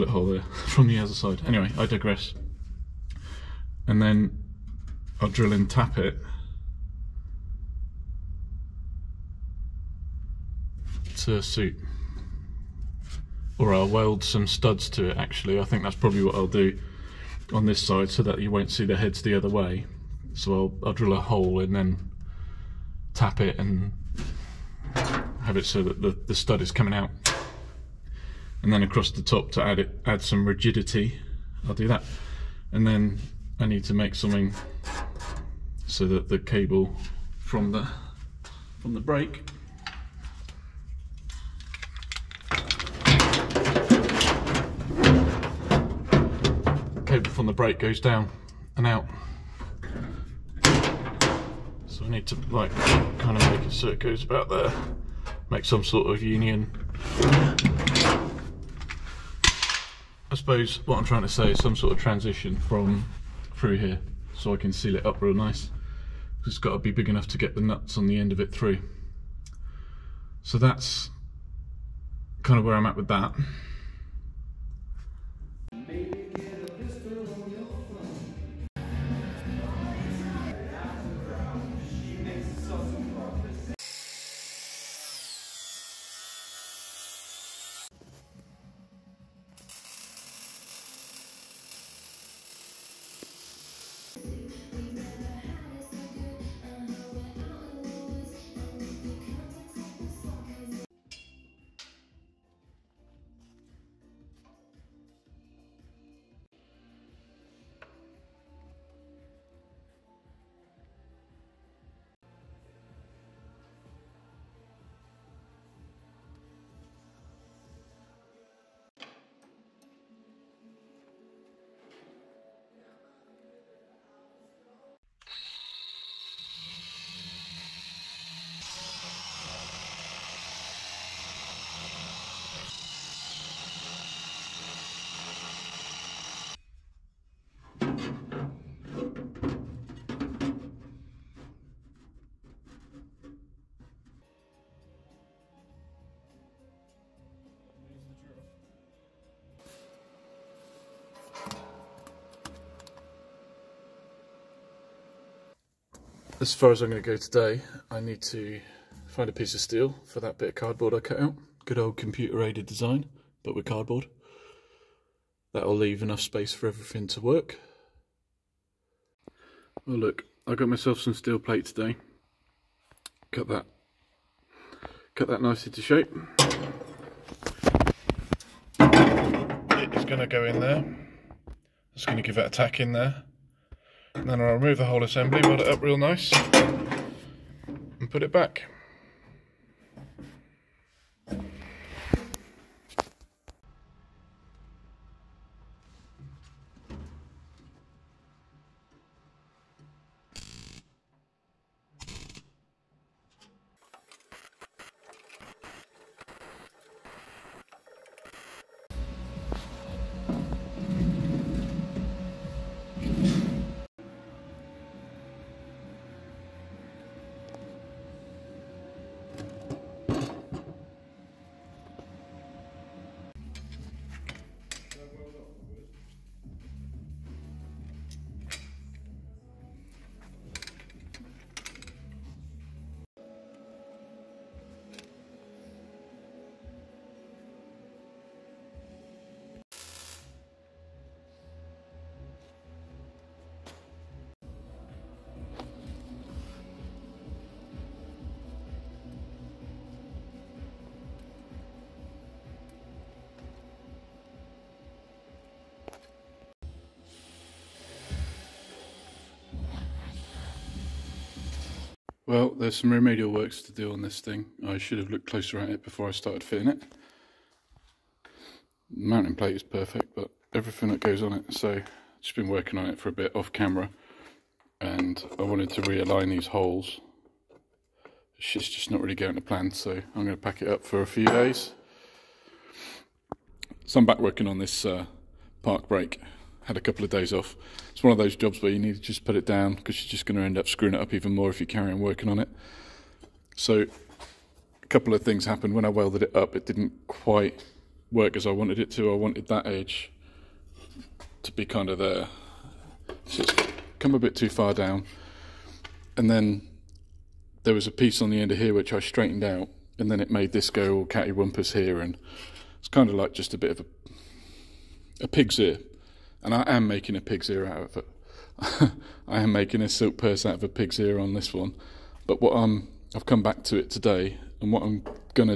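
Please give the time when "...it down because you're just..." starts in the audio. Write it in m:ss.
4:49.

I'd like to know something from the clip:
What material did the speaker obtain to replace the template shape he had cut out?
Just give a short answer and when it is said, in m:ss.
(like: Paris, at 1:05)
Steel plate, at 2:51.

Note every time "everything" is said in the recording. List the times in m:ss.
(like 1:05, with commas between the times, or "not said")
2:46, 4:30.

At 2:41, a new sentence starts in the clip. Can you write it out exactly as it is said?
Good old computer aided design, but with cardboard.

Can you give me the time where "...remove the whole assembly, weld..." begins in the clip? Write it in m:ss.
3:04.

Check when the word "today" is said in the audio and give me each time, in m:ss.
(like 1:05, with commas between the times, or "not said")
2:37, 2:51, 5:23.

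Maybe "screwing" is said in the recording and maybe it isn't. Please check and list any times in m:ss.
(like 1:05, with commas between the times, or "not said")
4:50.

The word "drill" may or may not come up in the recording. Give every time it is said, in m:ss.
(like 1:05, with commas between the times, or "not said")
0:05, 0:20.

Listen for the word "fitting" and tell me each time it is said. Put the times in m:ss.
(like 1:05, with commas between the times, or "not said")
4:26.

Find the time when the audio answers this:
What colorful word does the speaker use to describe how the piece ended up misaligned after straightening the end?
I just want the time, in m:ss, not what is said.
5:11.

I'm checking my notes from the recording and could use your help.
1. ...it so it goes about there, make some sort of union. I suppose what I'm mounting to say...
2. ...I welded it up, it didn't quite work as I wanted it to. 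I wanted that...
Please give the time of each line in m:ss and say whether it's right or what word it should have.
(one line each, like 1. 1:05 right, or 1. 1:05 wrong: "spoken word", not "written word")
1. 0:53 wrong: "trying", not "mounting"
2. 4:55 right.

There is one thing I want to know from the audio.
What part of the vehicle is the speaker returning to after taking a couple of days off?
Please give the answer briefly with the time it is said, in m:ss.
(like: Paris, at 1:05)
Park brake, at 4:45.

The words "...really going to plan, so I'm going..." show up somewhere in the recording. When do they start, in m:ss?
4:38.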